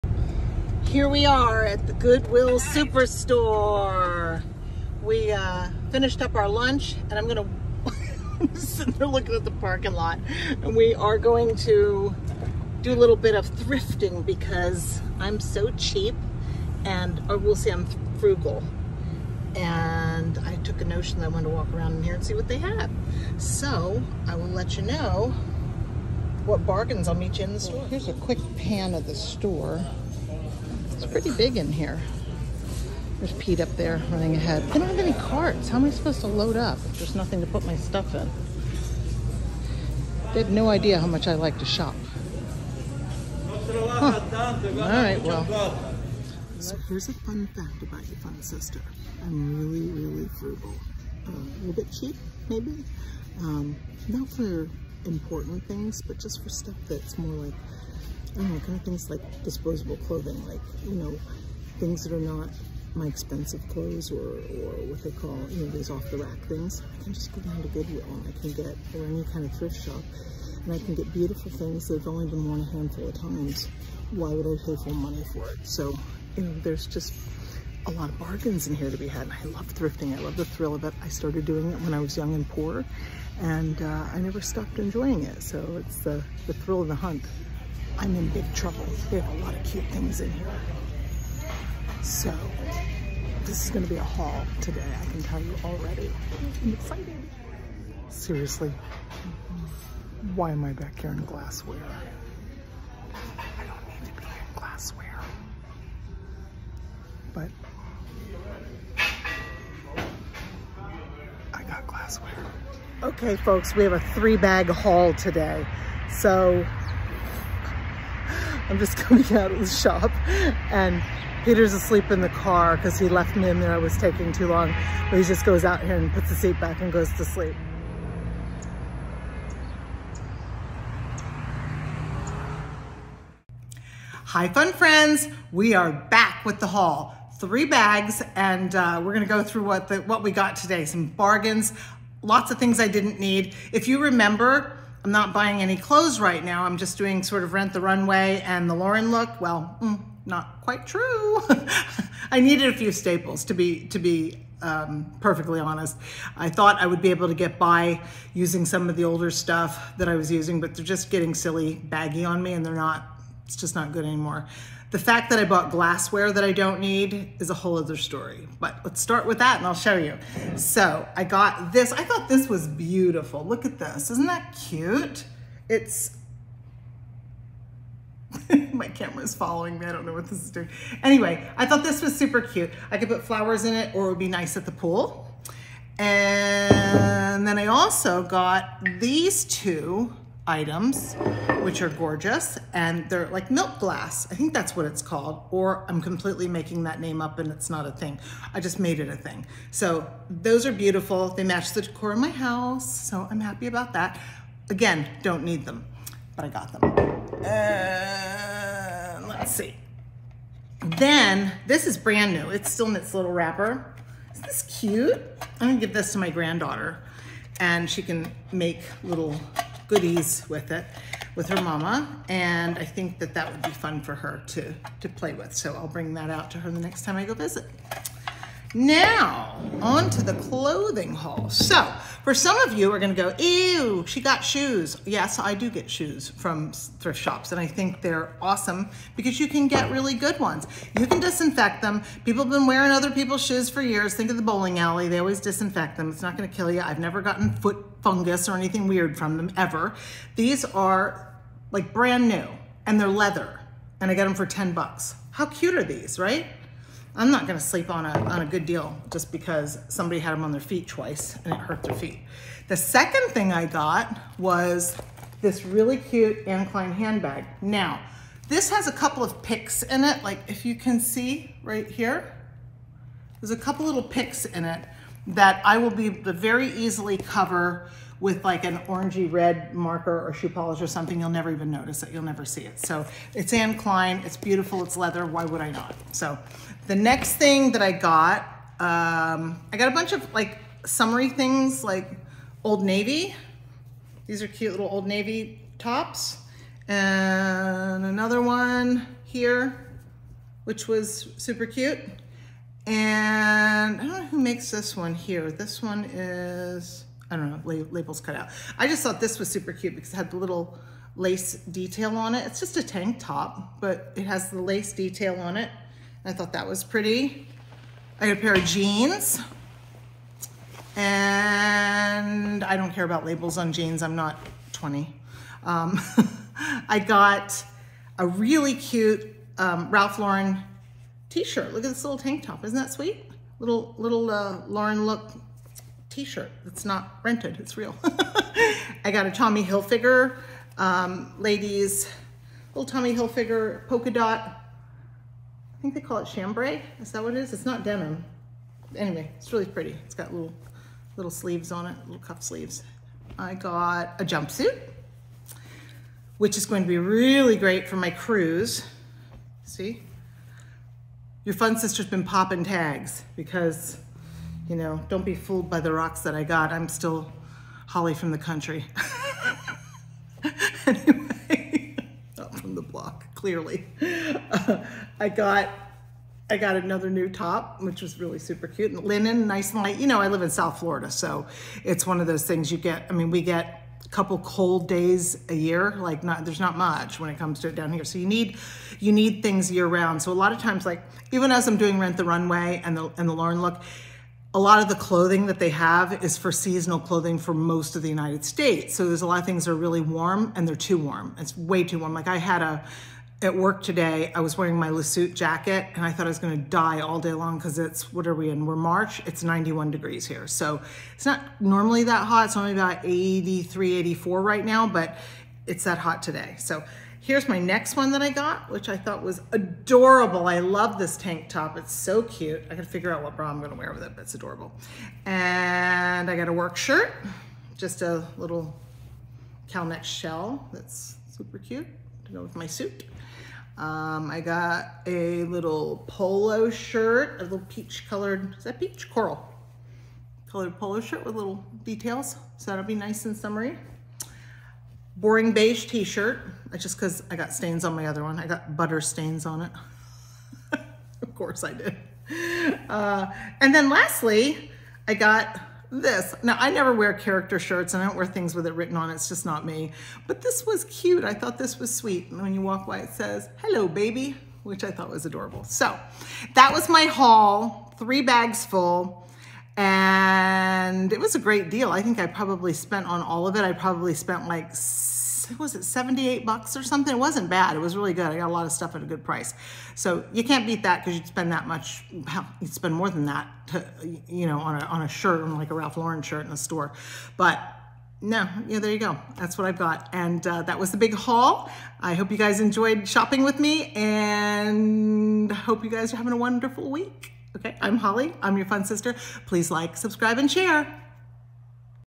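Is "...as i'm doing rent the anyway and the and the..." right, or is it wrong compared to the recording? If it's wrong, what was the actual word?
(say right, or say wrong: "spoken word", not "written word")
wrong: "runway", not "anyway".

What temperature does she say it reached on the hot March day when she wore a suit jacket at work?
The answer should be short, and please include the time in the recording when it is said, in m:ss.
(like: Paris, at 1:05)
91 degrees, at 6:49.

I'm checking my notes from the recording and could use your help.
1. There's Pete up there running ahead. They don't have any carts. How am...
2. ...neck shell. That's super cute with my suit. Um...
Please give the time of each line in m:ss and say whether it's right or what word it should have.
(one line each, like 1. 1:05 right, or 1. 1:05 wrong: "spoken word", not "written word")
1. 0:33 right
2. 7:09 right.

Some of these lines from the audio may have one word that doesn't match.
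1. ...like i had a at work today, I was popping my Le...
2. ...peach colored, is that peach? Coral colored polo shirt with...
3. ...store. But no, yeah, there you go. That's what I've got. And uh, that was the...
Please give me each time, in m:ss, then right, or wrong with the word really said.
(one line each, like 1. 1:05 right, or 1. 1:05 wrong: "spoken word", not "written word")
1. 6:42 wrong: "wearing", not "popping"
2. 7:17 right
3. 8:06 right.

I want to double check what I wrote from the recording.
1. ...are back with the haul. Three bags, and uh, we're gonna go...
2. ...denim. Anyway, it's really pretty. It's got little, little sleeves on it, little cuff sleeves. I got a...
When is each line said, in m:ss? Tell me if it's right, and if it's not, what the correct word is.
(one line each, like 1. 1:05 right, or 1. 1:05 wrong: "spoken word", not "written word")
1. 2:15 right
2. 5:47 right.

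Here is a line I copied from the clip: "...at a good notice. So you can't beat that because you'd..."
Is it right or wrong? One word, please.
wrong.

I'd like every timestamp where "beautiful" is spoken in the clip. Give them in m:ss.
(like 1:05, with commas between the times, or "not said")
1:11, 2:52, 3:20, 4:44.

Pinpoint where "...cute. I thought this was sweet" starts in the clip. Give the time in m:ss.
7:40.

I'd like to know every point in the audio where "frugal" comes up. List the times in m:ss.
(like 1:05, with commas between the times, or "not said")
0:18, 0:50.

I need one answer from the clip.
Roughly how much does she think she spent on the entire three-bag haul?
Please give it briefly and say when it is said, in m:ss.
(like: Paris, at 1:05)
$78, at 7:55.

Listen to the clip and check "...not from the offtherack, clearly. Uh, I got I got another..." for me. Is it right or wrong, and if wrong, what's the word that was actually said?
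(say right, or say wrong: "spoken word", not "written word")
wrong: "block", not "offtherack".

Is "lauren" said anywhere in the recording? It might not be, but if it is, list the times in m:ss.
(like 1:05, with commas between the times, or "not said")
2:28, 5:30, 5:34, 6:33, 8:05.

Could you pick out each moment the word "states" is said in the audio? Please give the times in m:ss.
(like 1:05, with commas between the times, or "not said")
6:38.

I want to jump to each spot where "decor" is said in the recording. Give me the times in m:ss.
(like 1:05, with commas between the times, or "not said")
3:21.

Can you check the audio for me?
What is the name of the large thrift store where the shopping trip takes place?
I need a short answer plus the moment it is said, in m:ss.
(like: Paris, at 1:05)
Goodwill Superstore, at 0:01.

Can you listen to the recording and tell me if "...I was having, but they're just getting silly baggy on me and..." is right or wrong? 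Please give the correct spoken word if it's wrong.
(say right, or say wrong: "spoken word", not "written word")
wrong: "using", not "having".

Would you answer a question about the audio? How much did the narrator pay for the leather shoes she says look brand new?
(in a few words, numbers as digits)
$10.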